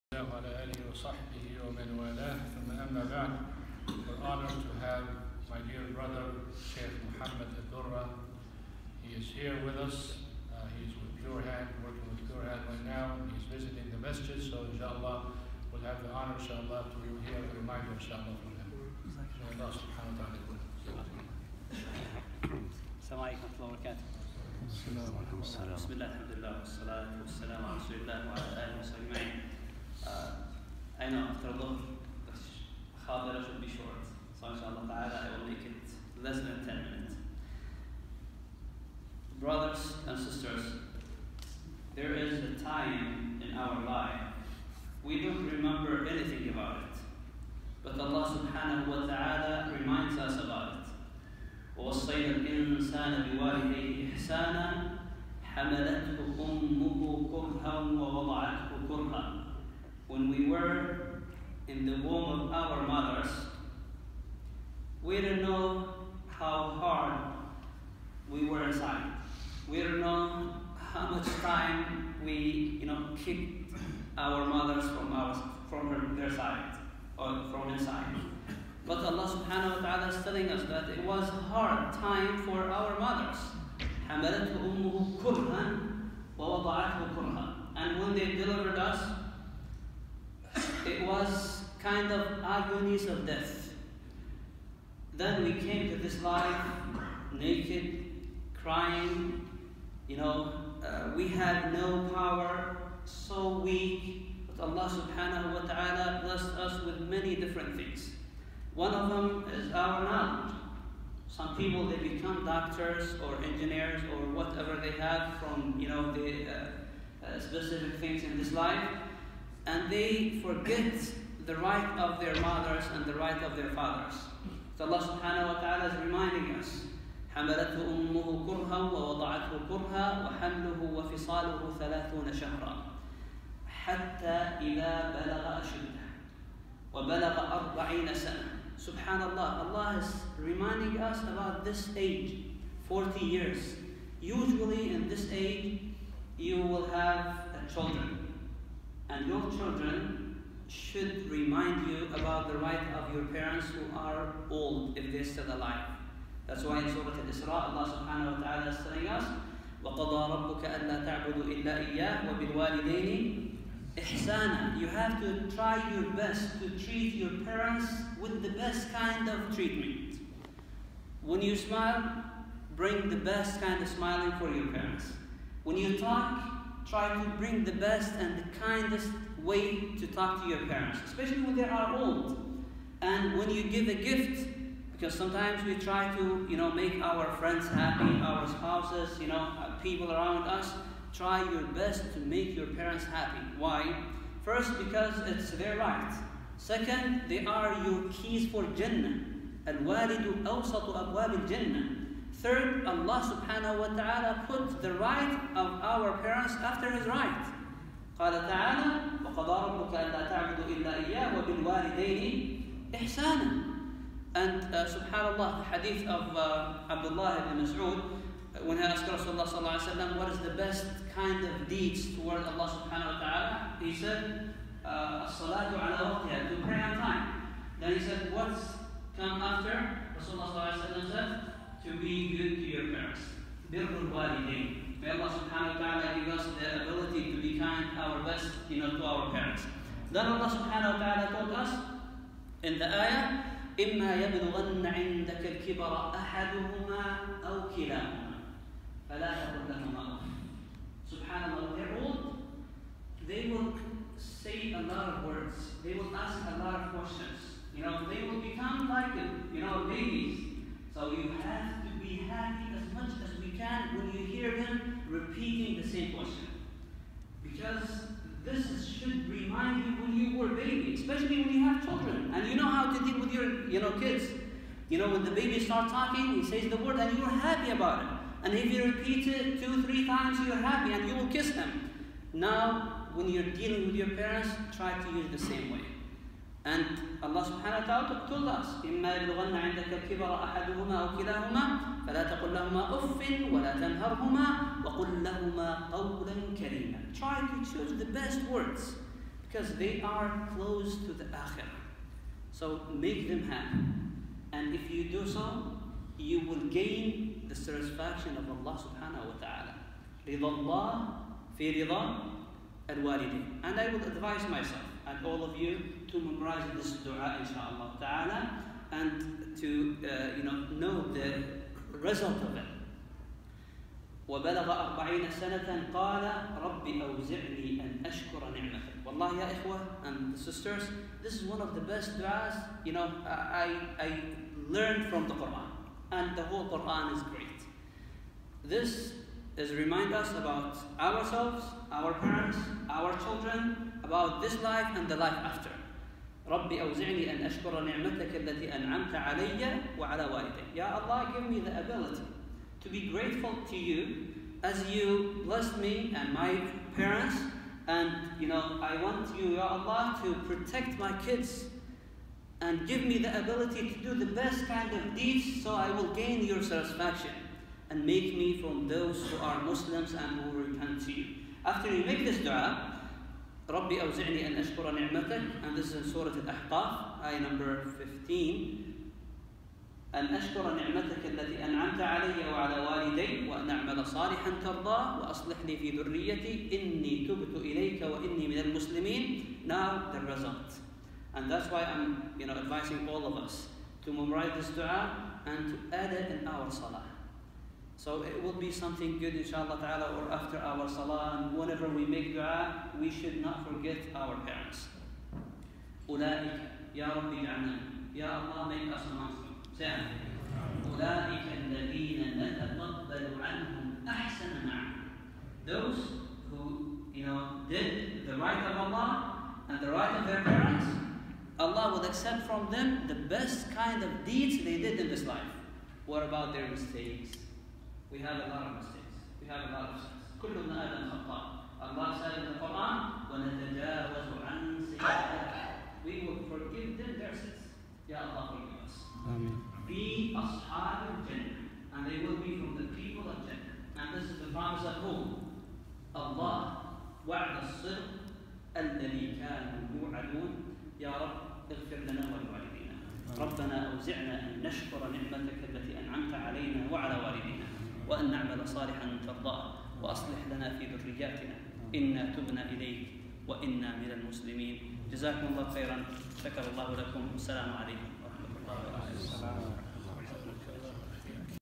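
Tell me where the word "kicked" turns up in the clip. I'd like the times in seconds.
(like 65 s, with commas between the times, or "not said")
73 s.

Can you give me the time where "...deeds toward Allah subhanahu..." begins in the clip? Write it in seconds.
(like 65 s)
221 s.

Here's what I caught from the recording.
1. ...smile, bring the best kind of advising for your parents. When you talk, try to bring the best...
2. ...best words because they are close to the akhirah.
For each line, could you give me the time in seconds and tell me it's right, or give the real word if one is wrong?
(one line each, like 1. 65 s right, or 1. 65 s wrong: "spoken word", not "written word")
1. 171 s wrong: "smiling", not "advising"
2. 298 s right.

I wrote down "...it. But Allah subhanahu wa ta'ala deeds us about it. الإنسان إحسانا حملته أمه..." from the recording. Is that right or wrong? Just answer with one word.
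wrong.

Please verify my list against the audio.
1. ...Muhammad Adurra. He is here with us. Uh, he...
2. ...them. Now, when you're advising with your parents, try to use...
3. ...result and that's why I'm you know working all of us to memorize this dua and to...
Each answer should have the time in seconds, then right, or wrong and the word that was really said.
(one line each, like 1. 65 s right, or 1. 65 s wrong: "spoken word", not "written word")
1. 7 s right
2. 281 s wrong: "dealing", not "advising"
3. 390 s wrong: "advising", not "working".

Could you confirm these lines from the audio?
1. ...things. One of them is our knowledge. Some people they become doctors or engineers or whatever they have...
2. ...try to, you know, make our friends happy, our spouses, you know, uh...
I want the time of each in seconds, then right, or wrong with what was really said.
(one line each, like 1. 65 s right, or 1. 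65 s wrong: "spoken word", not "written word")
1. 107 s right
2. 185 s right.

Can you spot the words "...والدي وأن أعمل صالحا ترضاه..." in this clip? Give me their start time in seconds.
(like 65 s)
382 s.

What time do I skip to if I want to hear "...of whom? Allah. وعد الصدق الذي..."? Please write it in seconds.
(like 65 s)
444 s.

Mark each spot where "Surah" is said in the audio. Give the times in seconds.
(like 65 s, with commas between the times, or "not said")
156 s, 376 s.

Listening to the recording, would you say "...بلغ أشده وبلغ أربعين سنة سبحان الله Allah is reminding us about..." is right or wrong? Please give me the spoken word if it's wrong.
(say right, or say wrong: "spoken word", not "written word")
right.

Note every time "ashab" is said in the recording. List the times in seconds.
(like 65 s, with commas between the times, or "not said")
440 s.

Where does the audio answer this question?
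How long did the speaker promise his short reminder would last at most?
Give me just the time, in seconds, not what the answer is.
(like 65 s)
36 s.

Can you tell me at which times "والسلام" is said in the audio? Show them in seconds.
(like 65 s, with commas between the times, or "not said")
27 s, 467 s.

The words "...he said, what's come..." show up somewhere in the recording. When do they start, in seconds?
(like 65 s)
227 s.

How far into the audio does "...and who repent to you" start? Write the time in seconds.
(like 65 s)
370 s.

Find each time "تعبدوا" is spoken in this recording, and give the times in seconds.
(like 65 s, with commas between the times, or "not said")
161 s, 210 s.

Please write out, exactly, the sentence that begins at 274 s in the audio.
You know, when the baby starts talking, he says the word and you're happy about it.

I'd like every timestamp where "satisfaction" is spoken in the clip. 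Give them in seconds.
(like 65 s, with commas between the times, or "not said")
307 s, 366 s.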